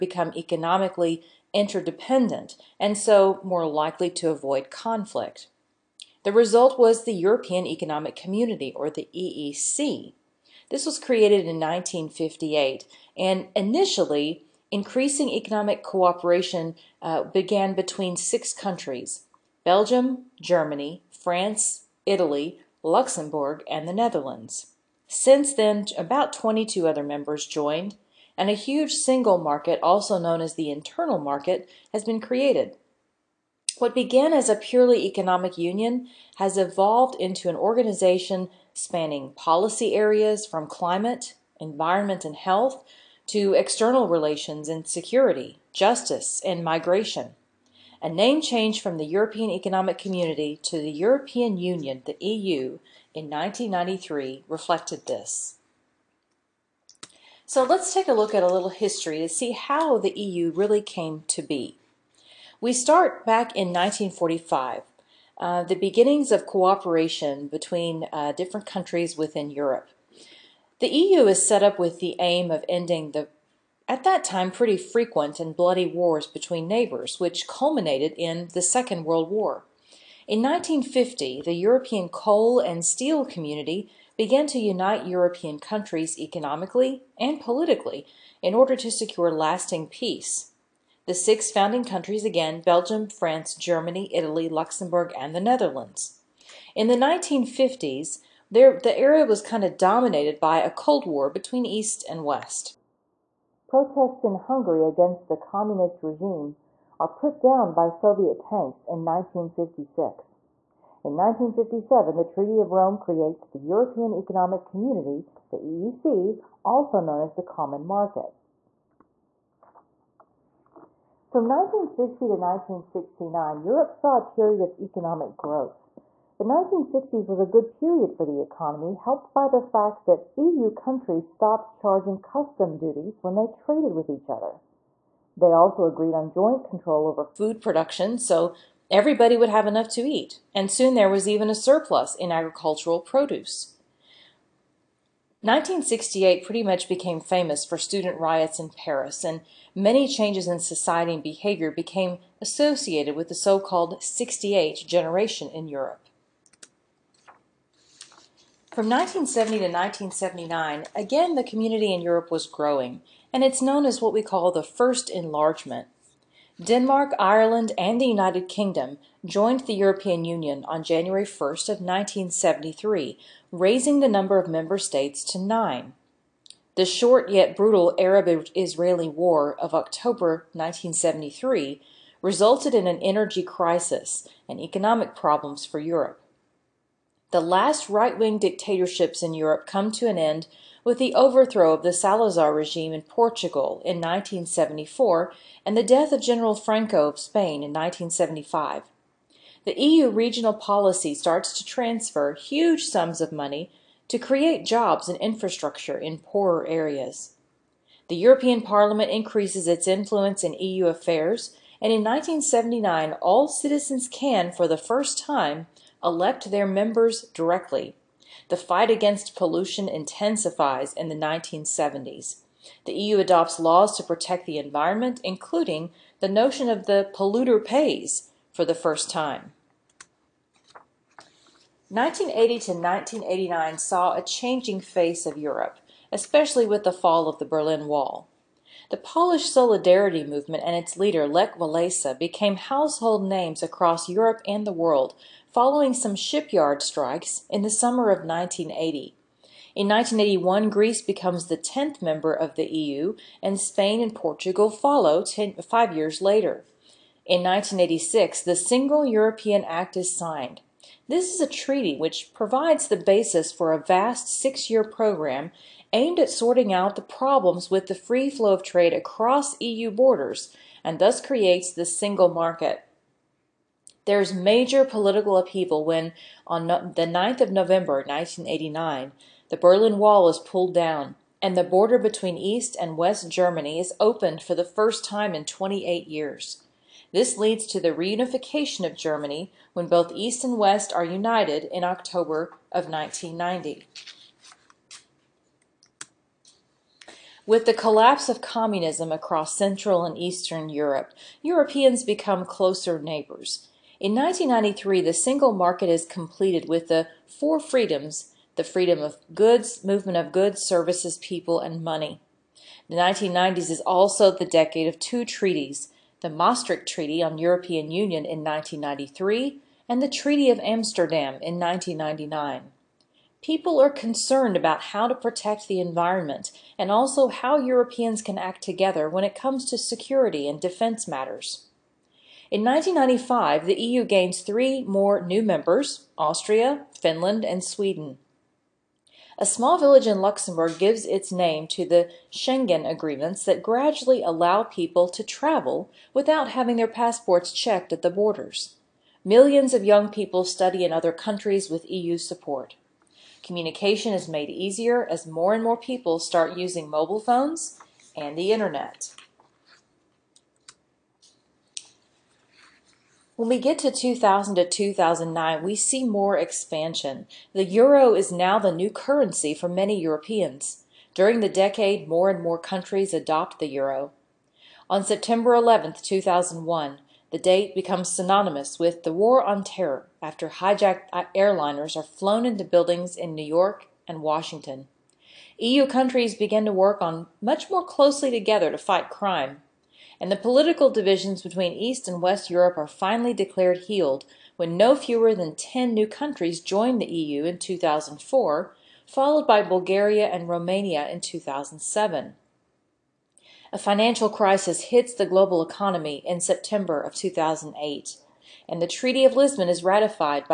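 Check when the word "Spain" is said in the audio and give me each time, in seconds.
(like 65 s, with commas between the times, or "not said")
197 s, 253 s.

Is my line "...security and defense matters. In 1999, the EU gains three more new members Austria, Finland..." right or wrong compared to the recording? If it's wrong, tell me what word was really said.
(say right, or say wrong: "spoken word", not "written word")
wrong: "1995", not "1999".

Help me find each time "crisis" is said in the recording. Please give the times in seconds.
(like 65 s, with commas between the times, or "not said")
183 s, 404 s.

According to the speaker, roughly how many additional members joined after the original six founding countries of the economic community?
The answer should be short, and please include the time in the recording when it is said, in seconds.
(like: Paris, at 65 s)
22, at 26 s.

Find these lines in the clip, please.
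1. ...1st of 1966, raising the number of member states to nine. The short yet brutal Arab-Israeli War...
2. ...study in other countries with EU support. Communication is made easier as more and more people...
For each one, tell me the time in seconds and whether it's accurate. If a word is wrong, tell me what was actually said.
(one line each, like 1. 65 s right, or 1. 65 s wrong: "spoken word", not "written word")
1. 171 s wrong: "1973", not "1966"
2. 350 s right.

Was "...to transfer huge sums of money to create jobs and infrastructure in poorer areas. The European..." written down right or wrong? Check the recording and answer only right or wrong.
right.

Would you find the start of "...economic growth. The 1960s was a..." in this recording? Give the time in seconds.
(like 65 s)
124 s.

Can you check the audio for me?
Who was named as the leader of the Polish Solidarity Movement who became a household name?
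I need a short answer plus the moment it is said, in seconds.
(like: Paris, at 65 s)
Lech Walesa, at 241 s.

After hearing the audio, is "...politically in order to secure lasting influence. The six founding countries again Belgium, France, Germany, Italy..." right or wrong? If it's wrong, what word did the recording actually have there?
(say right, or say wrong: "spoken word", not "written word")
wrong: "peace", not "influence".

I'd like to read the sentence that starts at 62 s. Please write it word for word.
We start back in 1945, uh, the beginnings of cooperation between uh, different countries within Europe.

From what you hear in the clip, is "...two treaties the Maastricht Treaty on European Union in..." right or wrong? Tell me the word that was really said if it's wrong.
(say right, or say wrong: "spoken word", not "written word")
right.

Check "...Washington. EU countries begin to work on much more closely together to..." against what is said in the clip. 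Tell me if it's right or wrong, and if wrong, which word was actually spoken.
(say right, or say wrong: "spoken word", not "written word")
right.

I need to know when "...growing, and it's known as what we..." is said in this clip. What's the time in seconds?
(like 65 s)
162 s.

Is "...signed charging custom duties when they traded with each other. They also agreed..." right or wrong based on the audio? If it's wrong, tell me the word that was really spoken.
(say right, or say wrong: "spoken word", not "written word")
wrong: "stopped", not "signed".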